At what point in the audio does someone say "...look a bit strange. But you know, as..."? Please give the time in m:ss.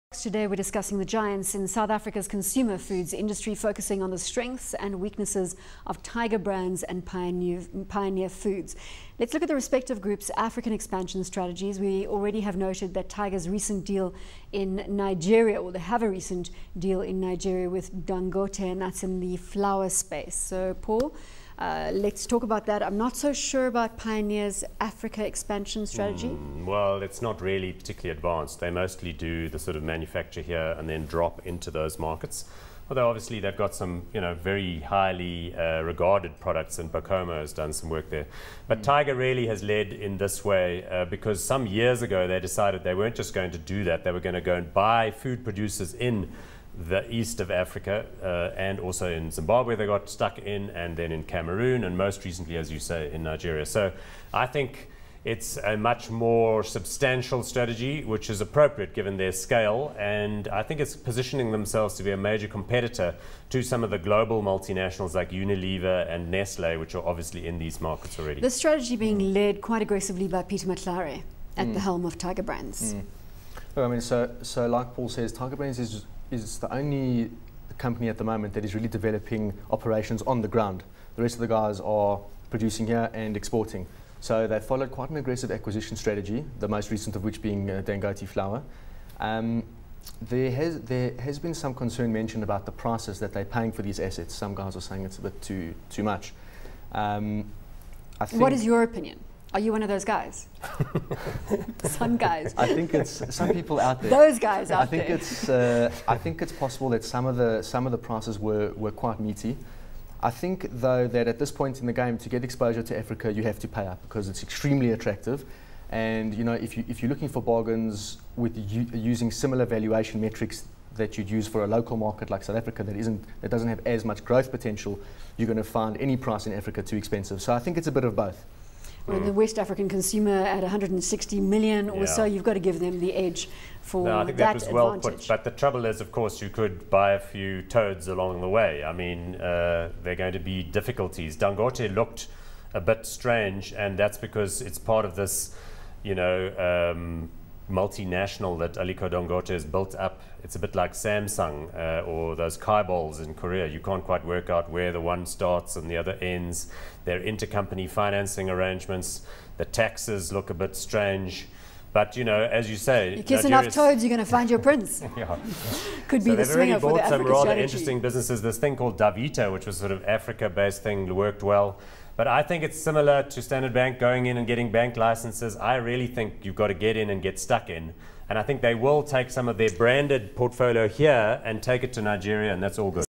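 2:40.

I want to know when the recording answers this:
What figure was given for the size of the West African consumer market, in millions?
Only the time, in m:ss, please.
2:10.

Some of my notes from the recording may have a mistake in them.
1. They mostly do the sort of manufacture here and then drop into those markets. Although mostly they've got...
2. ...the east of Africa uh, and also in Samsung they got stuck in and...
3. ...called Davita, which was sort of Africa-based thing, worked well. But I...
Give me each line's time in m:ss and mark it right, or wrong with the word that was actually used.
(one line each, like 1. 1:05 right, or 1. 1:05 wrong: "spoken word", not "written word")
1. 0:28 wrong: "obviously", not "mostly"
2. 0:46 wrong: "Zimbabwe", not "Samsung"
3. 2:48 right.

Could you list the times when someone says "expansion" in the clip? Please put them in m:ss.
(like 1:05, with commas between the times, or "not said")
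0:10, 0:25.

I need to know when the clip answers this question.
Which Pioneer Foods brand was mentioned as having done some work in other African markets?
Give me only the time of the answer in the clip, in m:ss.
0:36.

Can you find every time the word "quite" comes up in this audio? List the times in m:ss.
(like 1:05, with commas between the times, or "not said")
1:09, 1:24, 1:48, 2:34.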